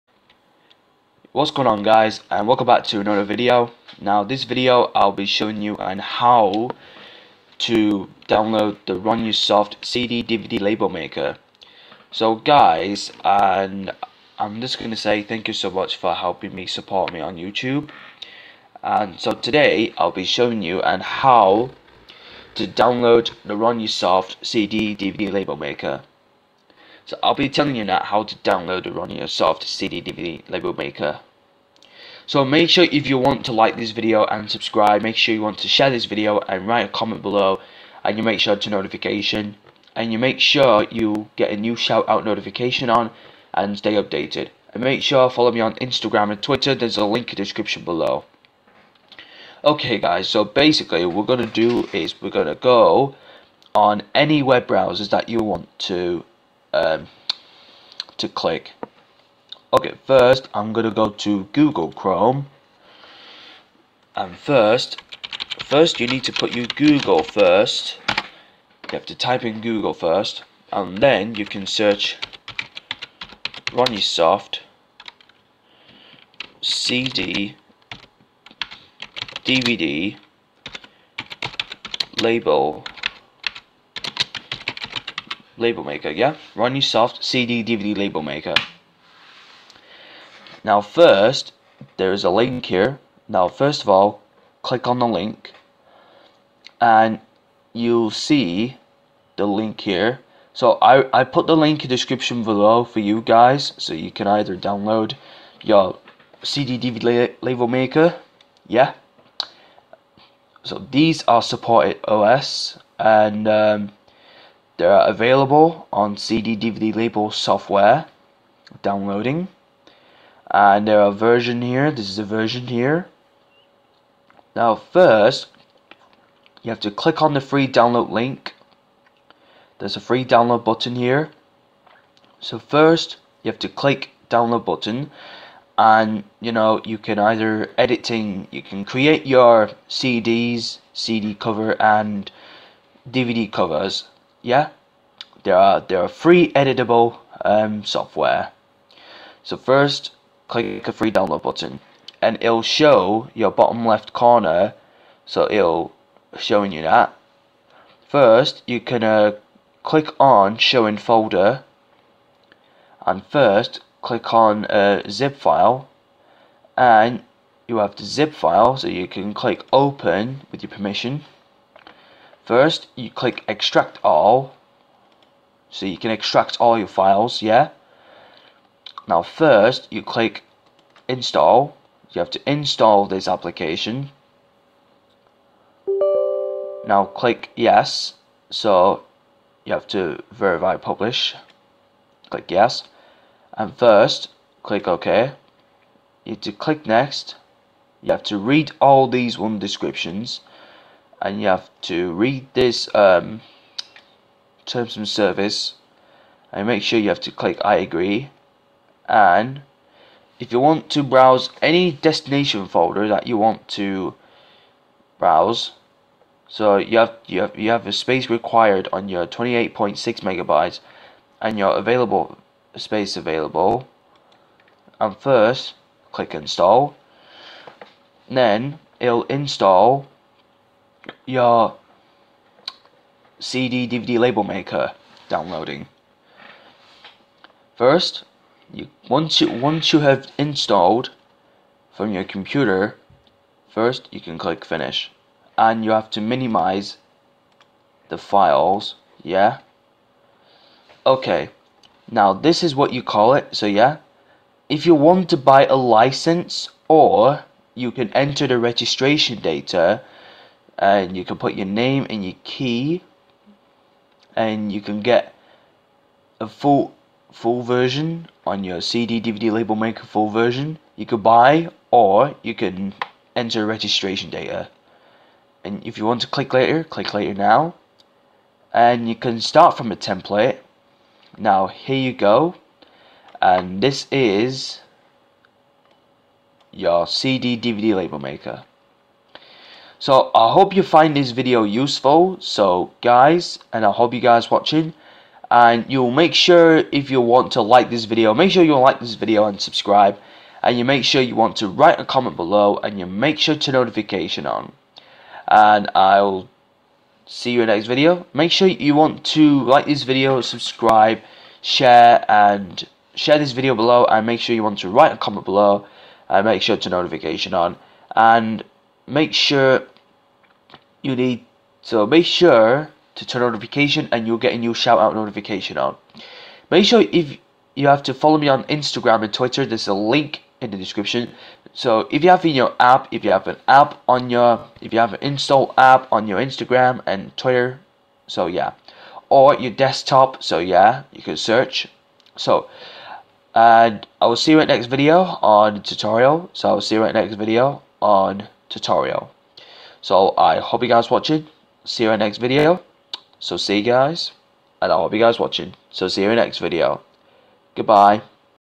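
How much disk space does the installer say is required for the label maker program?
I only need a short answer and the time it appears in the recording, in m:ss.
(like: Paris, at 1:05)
28.6 megabytes, at 3:39.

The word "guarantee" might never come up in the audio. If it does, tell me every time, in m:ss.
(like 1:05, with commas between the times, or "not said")
not said.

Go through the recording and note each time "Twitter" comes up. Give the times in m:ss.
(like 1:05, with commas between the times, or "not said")
0:46, 5:29, 5:37.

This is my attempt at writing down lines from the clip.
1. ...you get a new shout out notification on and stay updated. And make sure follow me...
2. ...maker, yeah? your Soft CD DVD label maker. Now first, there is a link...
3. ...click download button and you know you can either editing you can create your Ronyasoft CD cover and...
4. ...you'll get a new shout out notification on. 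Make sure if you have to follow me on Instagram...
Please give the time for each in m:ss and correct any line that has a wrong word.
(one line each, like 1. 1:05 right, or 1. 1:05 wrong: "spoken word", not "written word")
1. 0:40 right
2. 1:25 right
3. 2:13 wrong: "CDs", not "Ronyasoft"
4. 5:24 right.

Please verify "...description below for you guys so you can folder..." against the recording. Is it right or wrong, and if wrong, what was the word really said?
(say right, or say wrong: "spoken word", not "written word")
wrong: "either", not "folder".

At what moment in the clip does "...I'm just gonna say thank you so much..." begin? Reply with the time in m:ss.
0:14.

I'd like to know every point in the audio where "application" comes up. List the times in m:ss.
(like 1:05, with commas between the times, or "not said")
3:03.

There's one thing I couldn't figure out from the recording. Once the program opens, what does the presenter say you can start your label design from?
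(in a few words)
a template.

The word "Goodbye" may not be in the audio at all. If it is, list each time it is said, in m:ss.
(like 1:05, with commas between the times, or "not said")
5:57.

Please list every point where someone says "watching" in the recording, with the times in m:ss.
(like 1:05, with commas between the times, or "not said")
4:54, 5:51, 5:55.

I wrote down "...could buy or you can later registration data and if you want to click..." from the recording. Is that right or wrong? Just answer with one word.
wrong.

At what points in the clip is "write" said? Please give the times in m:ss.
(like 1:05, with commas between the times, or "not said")
0:36, 5:01, 5:14.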